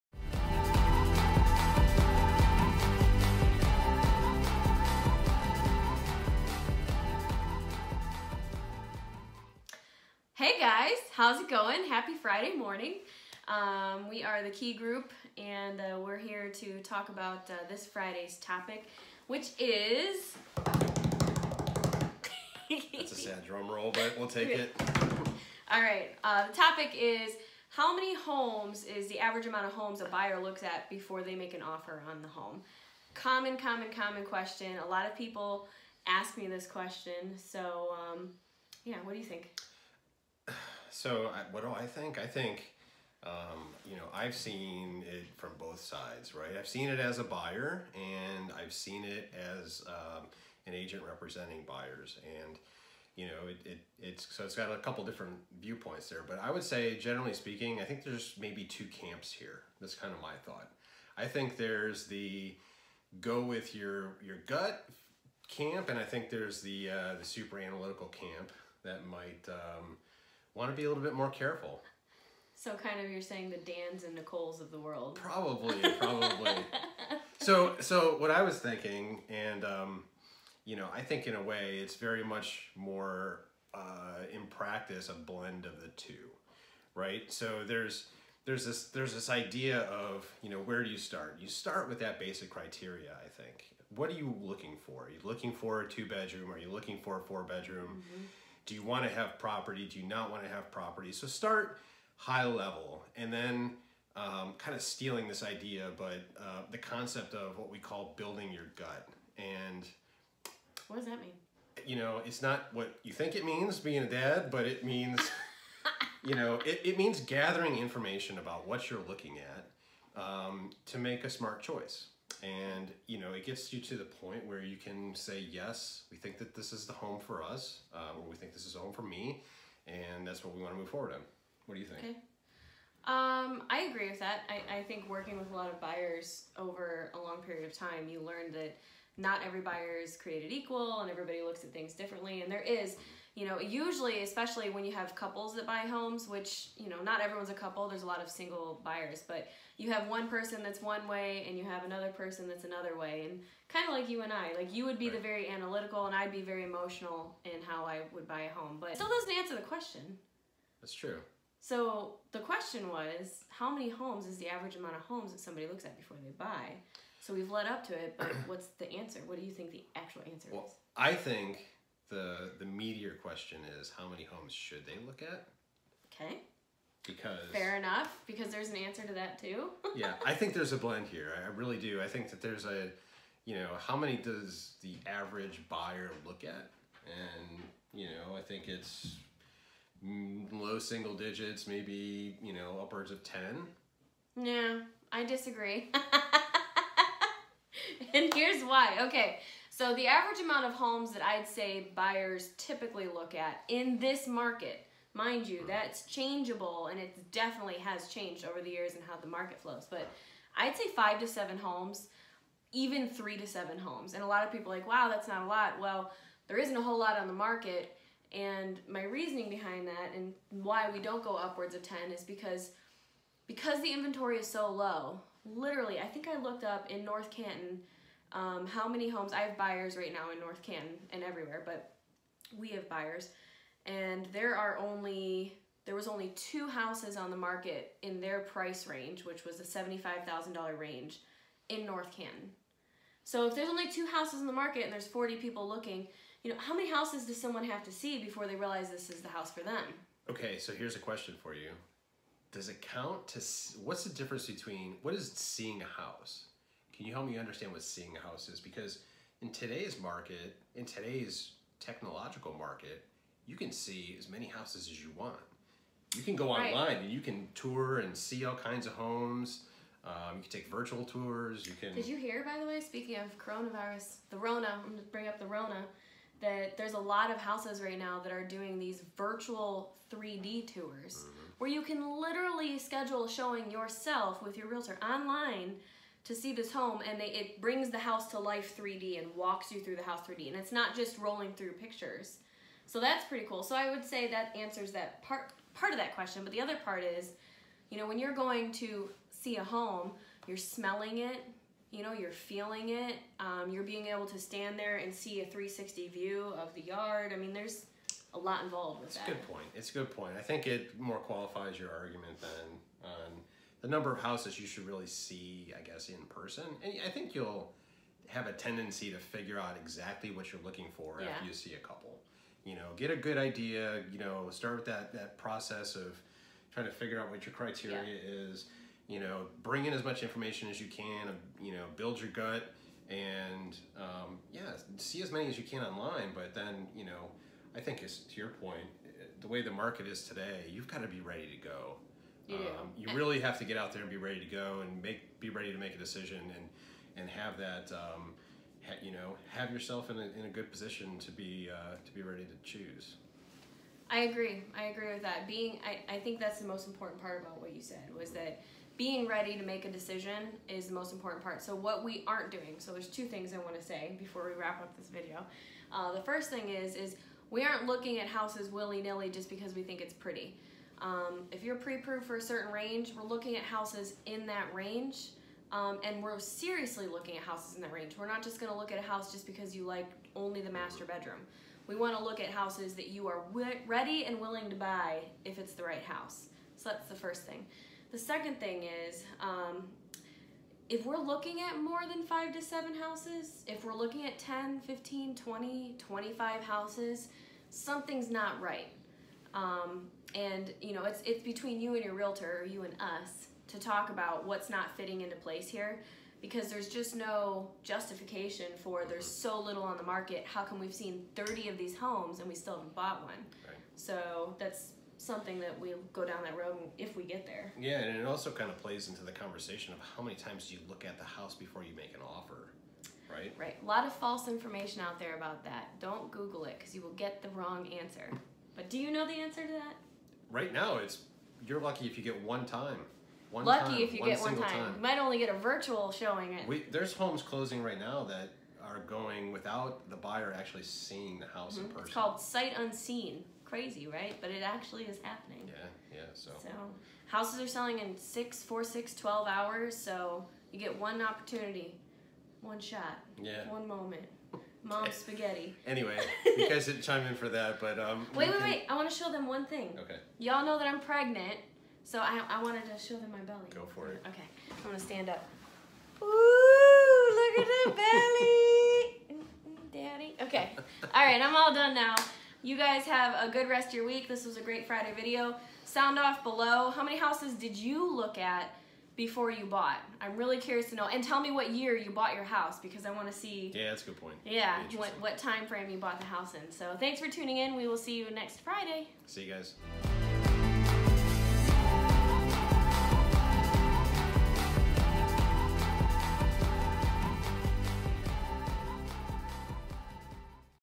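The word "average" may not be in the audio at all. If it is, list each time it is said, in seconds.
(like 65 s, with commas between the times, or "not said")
29 s, 164 s, 185 s, 200 s.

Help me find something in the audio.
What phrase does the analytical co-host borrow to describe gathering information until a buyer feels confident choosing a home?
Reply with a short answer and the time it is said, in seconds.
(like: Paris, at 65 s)
building your gut, at 108 s.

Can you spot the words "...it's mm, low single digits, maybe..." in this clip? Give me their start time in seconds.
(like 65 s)
188 s.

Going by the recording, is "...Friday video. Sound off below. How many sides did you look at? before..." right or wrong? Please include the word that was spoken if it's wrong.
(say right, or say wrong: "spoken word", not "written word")
wrong: "houses", not "sides".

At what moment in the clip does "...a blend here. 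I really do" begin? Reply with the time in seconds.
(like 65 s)
180 s.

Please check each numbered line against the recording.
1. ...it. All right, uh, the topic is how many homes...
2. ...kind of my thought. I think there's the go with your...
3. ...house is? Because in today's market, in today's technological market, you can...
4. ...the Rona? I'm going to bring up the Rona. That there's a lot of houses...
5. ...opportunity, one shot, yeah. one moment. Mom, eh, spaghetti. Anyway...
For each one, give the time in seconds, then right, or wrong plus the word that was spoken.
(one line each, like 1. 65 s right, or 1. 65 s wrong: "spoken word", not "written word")
1. 24 s right
2. 59 s right
3. 258 s right
4. 274 s right
5. 451 s right.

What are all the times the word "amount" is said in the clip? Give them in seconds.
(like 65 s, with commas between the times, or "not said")
29 s, 164 s, 200 s.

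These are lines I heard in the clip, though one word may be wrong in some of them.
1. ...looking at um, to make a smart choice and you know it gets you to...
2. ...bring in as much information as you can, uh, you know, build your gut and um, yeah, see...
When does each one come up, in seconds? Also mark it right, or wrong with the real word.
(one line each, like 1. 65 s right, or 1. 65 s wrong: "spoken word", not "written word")
1. 119 s right
2. 329 s right.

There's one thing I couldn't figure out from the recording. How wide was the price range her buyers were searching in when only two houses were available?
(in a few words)
$75,000.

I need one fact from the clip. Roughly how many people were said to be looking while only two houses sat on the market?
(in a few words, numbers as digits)
40.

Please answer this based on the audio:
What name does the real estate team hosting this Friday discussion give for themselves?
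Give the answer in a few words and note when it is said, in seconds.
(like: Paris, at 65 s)
Key Group, at 14 s.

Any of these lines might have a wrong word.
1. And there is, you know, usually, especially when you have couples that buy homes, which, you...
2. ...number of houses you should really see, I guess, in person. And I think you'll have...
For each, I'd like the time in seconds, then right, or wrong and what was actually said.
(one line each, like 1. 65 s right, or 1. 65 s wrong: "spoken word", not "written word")
1. 142 s right
2. 313 s right.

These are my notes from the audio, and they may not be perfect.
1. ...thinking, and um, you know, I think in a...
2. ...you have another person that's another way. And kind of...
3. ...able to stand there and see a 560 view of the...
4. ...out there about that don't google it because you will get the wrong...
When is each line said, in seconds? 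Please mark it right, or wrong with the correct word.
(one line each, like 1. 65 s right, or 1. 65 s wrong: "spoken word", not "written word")
1. 78 s right
2. 151 s right
3. 304 s wrong: "360", not "560"
4. 425 s right.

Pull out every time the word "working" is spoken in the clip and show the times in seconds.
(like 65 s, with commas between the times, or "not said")
135 s.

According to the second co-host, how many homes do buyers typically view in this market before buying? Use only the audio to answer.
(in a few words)
5 to 7.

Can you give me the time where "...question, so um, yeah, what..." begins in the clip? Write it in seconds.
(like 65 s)
36 s.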